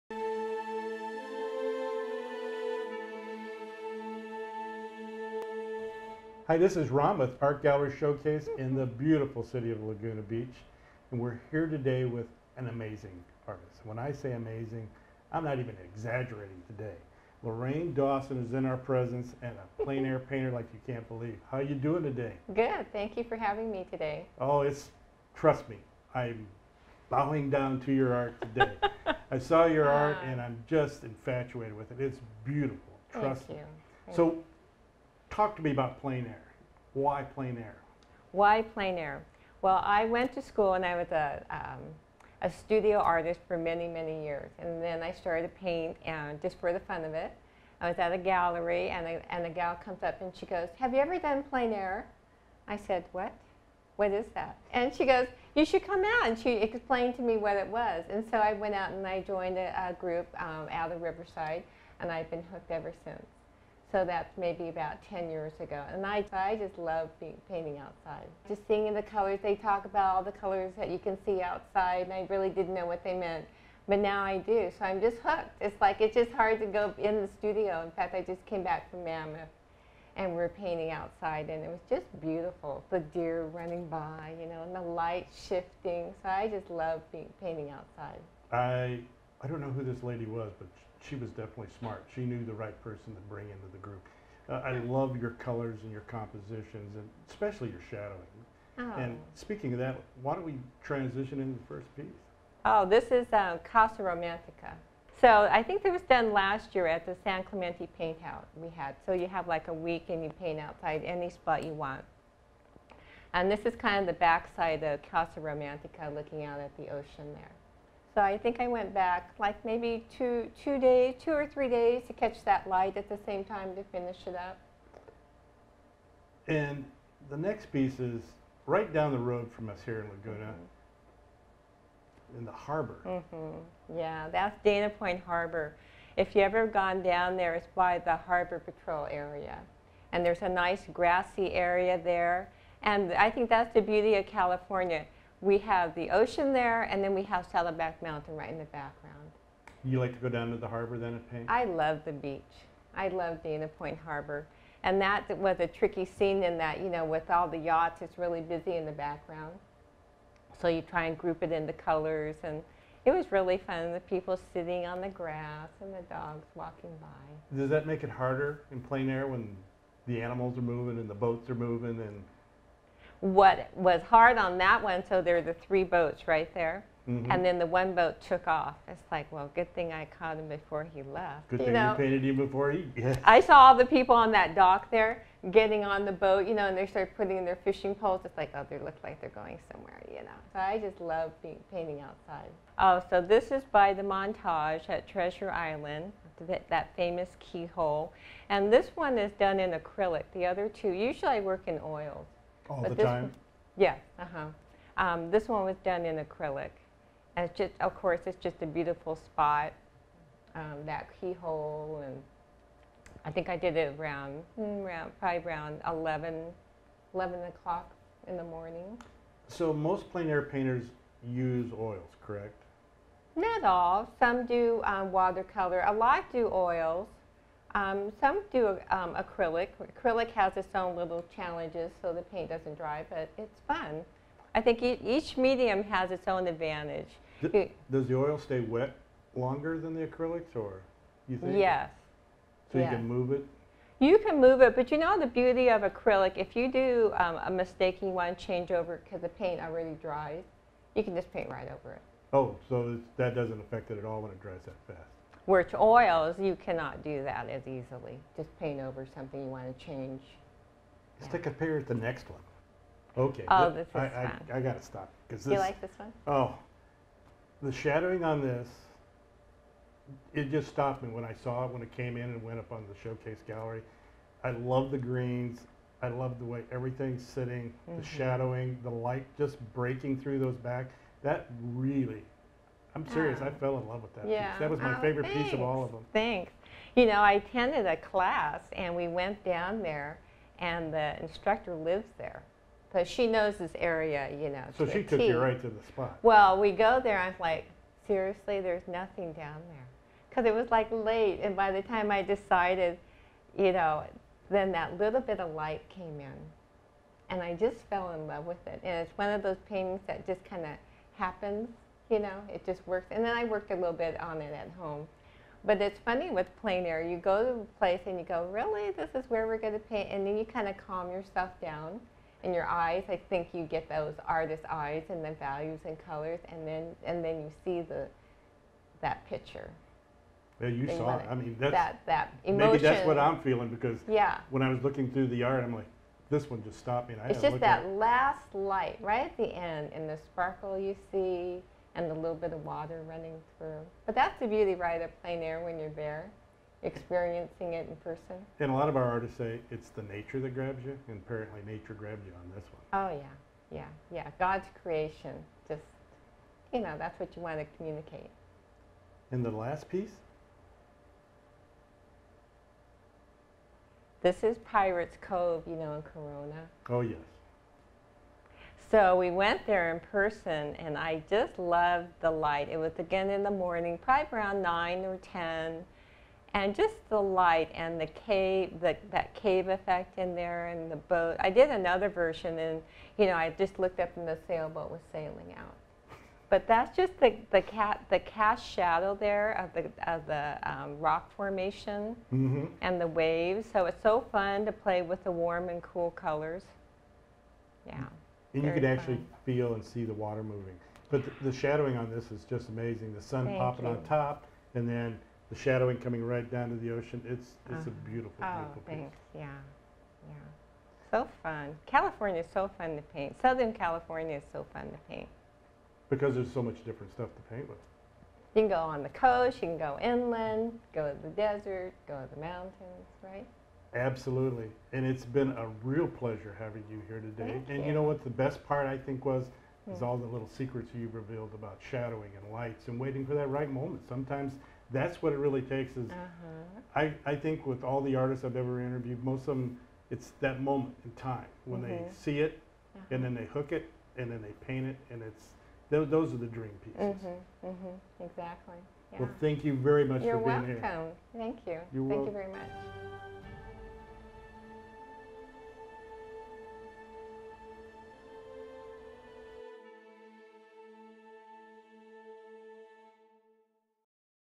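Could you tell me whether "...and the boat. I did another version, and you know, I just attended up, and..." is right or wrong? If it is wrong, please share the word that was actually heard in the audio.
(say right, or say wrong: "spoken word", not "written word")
wrong: "looked", not "attended".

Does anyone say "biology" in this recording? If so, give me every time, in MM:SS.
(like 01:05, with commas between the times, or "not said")
not said.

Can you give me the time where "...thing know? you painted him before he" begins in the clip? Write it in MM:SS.
03:01.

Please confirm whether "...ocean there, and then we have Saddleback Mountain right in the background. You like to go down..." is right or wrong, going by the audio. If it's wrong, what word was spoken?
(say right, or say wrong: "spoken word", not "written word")
right.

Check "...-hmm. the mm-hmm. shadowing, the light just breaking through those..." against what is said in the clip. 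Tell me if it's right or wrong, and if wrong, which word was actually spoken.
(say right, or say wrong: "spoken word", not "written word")
right.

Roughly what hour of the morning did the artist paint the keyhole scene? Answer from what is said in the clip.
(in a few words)
11 o'clock.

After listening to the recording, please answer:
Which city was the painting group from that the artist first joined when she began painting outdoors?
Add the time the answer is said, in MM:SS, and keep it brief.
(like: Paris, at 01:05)
Riverside, at 01:01.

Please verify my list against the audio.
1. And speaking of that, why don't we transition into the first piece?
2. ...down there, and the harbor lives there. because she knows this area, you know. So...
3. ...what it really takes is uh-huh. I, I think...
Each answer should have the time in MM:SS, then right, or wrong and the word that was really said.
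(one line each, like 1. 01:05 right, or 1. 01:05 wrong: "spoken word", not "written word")
1. 01:39 right
2. 04:49 wrong: "instructor", not "harbor"
3. 07:15 right.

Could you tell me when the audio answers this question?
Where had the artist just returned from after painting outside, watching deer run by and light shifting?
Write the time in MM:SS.
01:19.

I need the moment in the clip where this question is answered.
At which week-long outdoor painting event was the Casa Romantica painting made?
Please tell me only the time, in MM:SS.
01:47.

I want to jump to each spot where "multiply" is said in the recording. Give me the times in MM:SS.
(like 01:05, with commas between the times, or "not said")
not said.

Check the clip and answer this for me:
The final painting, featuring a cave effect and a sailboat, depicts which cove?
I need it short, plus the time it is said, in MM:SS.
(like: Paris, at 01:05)
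Pirates Cove, at 06:04.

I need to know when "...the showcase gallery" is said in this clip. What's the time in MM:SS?
04:32.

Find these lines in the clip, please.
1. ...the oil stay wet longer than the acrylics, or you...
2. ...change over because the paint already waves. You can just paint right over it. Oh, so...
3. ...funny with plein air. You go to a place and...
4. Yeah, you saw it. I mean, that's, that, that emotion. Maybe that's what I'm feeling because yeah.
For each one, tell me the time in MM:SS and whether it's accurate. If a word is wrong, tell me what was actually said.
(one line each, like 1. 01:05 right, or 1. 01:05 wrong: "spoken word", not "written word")
1. 03:58 right
2. 04:08 wrong: "dries", not "waves"
3. 05:16 right
4. 05:30 right.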